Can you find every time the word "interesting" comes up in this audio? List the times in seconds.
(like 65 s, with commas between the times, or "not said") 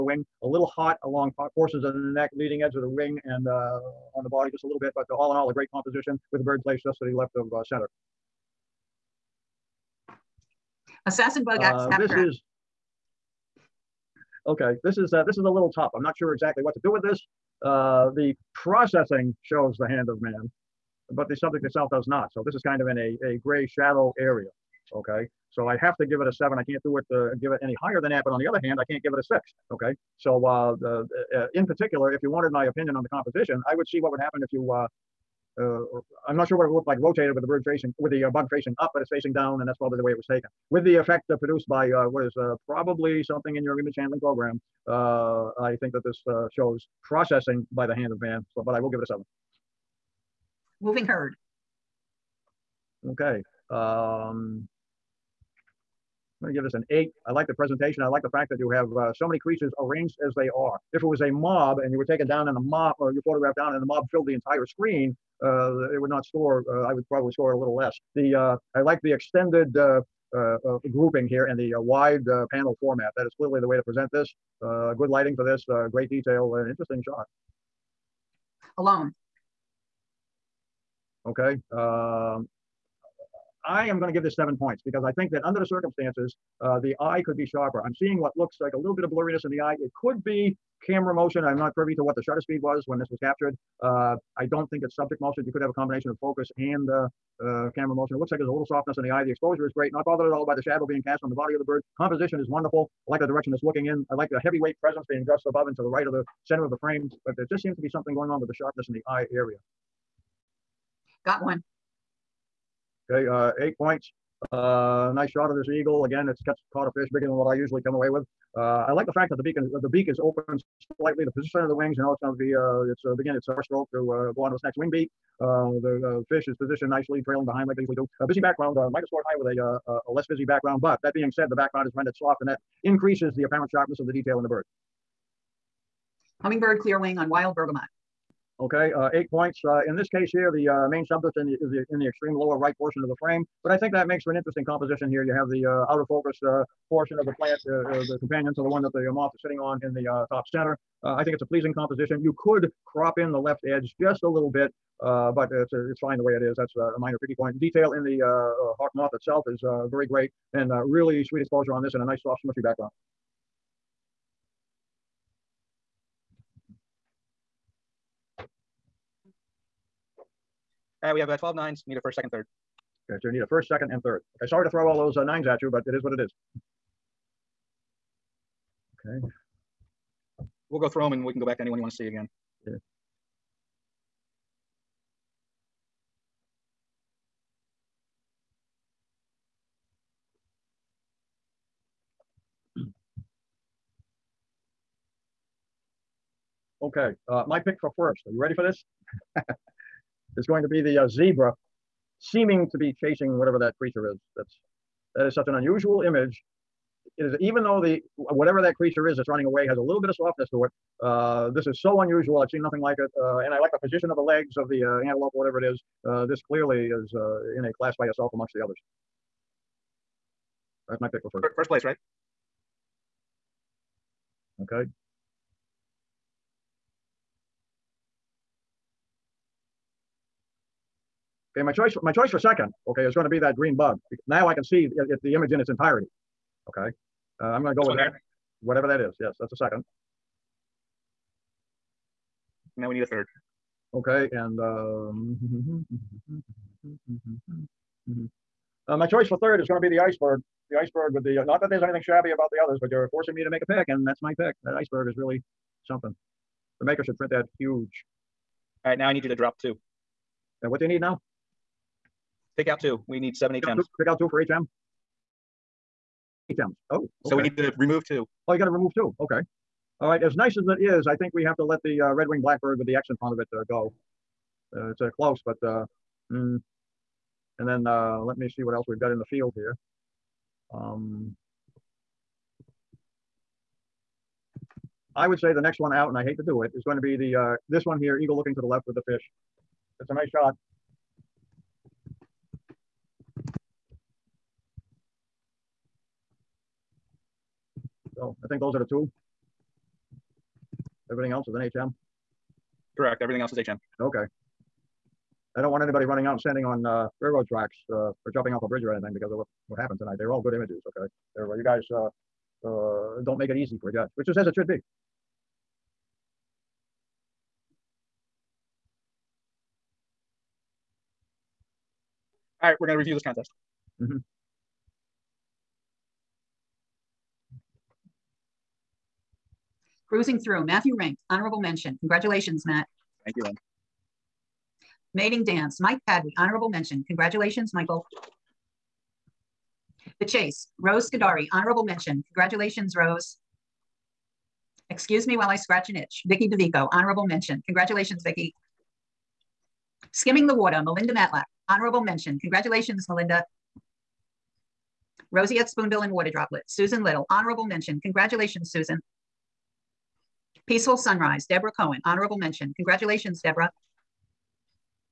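76 s, 144 s.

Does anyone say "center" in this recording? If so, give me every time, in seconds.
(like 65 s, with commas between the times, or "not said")
7 s, 106 s, 150 s.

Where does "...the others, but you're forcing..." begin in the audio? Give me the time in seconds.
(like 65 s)
252 s.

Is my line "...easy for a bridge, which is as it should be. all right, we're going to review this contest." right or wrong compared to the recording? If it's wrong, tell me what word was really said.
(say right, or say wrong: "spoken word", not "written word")
wrong: "judge", not "bridge".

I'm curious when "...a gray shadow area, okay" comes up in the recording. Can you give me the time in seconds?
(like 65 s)
23 s.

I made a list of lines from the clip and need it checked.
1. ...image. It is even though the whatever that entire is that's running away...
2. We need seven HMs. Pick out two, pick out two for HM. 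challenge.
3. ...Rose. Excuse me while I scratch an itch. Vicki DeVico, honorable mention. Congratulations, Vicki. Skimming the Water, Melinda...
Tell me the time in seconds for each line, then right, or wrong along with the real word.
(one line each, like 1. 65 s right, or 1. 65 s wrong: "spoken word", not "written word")
1. 206 s wrong: "creature", not "entire"
2. 263 s right
3. 342 s right.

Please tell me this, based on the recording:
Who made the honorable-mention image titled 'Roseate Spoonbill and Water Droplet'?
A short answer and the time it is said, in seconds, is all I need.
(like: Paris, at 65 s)
Susan Little, at 356 s.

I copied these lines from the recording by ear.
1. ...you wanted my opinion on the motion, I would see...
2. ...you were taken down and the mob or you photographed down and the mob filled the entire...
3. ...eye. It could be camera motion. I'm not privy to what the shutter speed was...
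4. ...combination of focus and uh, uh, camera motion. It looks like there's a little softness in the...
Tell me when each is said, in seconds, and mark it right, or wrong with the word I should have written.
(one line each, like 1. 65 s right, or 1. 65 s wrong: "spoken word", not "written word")
1. 32 s wrong: "composition", not "motion"
2. 61 s right
3. 89 s right
4. 95 s right.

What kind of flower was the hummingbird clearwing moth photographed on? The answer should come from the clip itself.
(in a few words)
Wild bergamot.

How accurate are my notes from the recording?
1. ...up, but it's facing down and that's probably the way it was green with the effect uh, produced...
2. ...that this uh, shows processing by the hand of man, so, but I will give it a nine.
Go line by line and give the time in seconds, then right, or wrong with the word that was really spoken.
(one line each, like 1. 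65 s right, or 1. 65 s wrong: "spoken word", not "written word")
1. 38 s wrong: "taken", not "green"
2. 45 s wrong: "seven", not "nine".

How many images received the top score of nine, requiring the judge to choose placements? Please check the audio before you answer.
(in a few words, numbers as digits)
12.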